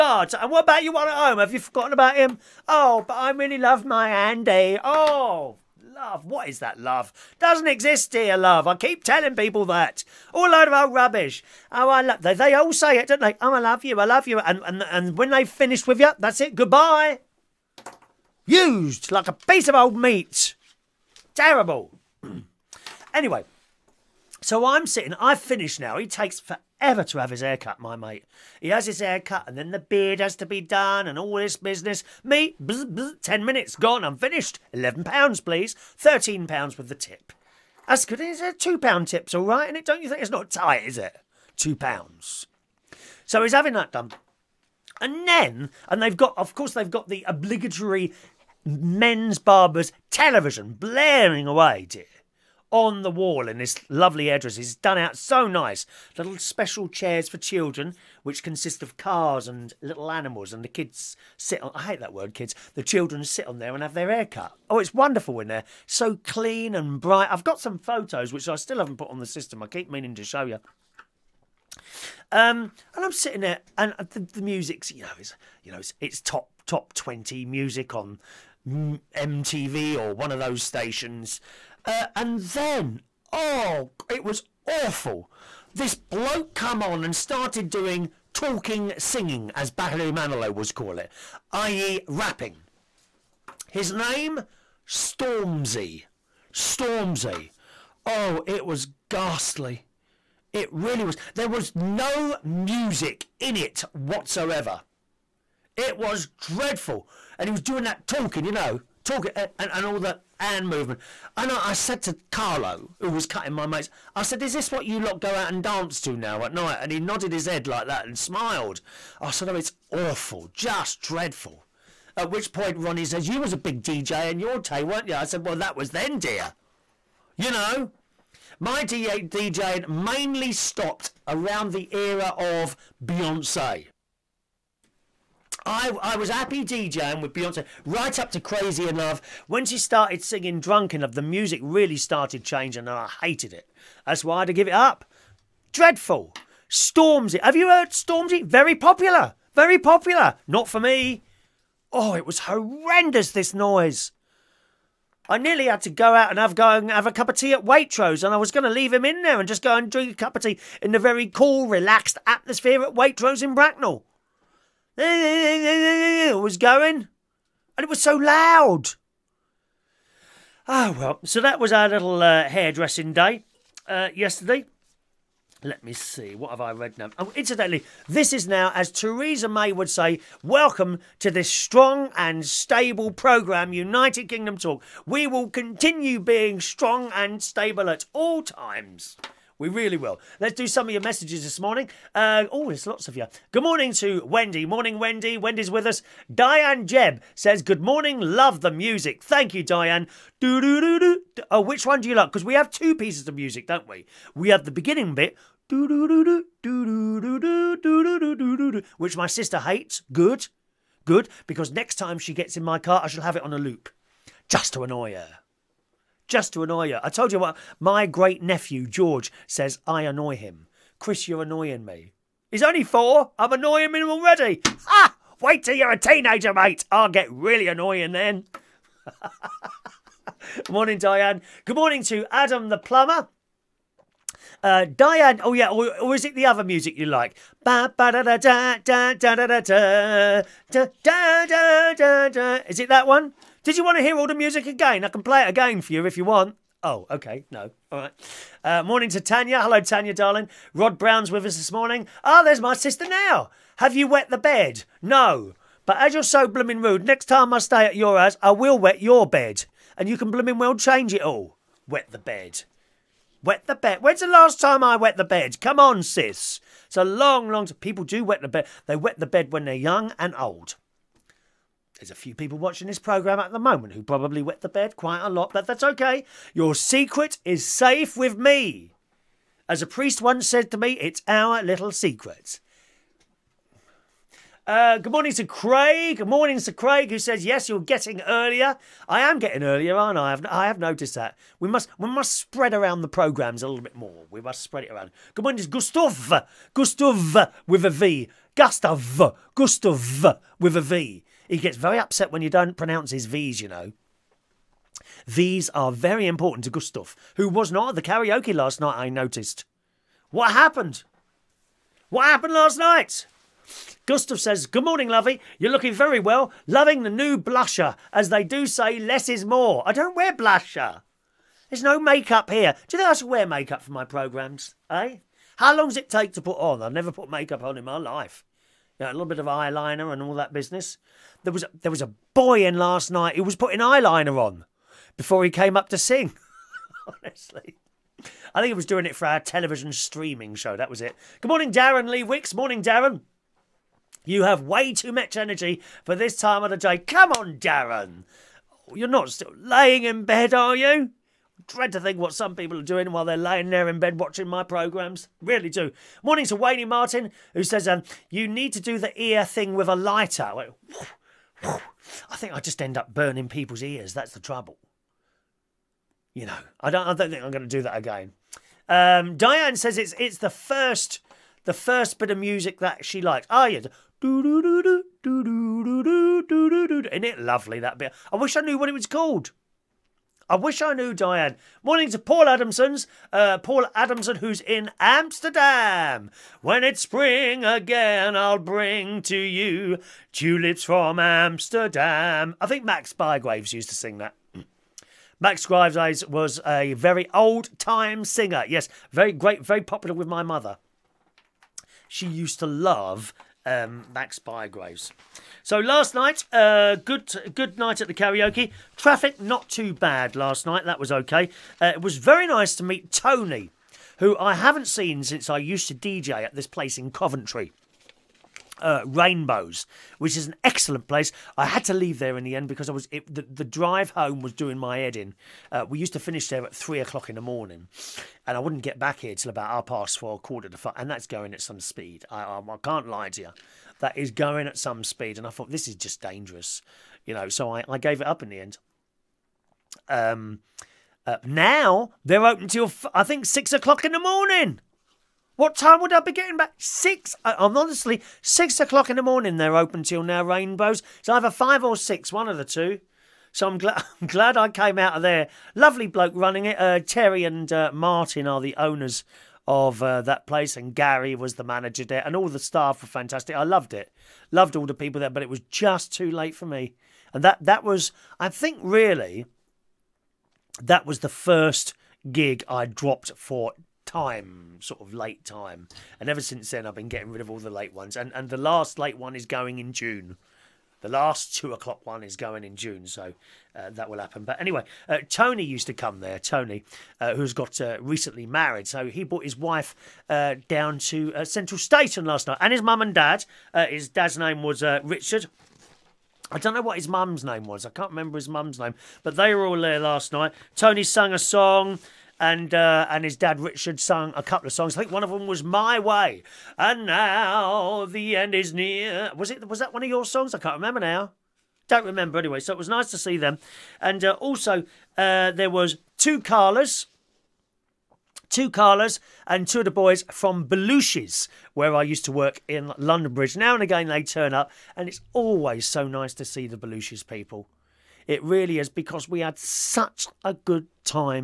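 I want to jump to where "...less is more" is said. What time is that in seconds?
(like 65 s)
318 s.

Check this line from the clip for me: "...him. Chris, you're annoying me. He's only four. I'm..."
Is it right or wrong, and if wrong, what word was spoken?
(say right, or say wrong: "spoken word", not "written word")
right.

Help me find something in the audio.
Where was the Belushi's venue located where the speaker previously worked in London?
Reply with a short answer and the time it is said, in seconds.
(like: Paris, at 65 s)
London Bridge, at 522 s.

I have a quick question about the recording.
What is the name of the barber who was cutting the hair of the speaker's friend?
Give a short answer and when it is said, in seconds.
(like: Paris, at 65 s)
Carlo, at 112 s.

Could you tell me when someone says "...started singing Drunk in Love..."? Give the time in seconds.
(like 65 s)
139 s.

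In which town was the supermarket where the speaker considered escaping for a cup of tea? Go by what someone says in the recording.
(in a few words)
Bracknell.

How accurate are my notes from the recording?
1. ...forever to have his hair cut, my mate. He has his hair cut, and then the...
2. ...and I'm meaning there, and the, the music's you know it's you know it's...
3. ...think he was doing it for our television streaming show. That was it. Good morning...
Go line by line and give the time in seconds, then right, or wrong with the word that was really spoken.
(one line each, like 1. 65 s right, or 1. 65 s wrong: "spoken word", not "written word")
1. 26 s right
2. 72 s wrong: "sitting", not "meaning"
3. 338 s right.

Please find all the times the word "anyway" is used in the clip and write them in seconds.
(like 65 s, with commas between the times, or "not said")
23 s, 484 s, 512 s.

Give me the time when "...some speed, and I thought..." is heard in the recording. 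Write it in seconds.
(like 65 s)
434 s.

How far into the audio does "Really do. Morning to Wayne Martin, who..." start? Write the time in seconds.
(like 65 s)
355 s.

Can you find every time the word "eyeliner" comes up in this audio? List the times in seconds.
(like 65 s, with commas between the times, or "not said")
329 s, 333 s.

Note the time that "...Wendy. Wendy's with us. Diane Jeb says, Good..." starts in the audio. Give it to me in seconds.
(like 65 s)
194 s.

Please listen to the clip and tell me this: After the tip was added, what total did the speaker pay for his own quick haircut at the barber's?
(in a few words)
£13.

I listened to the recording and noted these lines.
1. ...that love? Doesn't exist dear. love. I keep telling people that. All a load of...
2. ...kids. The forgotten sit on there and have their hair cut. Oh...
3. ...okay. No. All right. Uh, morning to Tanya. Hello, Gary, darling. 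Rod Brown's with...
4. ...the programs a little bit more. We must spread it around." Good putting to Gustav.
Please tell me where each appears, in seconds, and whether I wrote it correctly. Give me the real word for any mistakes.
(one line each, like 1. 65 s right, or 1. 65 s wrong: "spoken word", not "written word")
1. 6 s right
2. 62 s wrong: "children", not "forgotten"
3. 247 s wrong: "Tanya", not "Gary"
4. 293 s wrong: "morning", not "putting".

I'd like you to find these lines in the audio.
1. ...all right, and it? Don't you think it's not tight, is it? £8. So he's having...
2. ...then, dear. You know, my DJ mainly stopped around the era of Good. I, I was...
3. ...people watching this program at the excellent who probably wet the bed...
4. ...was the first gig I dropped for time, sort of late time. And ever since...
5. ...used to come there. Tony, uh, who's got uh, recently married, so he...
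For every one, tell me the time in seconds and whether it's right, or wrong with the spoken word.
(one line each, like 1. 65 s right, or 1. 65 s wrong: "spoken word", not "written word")
1. 39 s wrong: "2", not "8"
2. 125 s wrong: "Beyonce", not "Good"
3. 272 s wrong: "moment", not "excellent"
4. 471 s right
5. 485 s right.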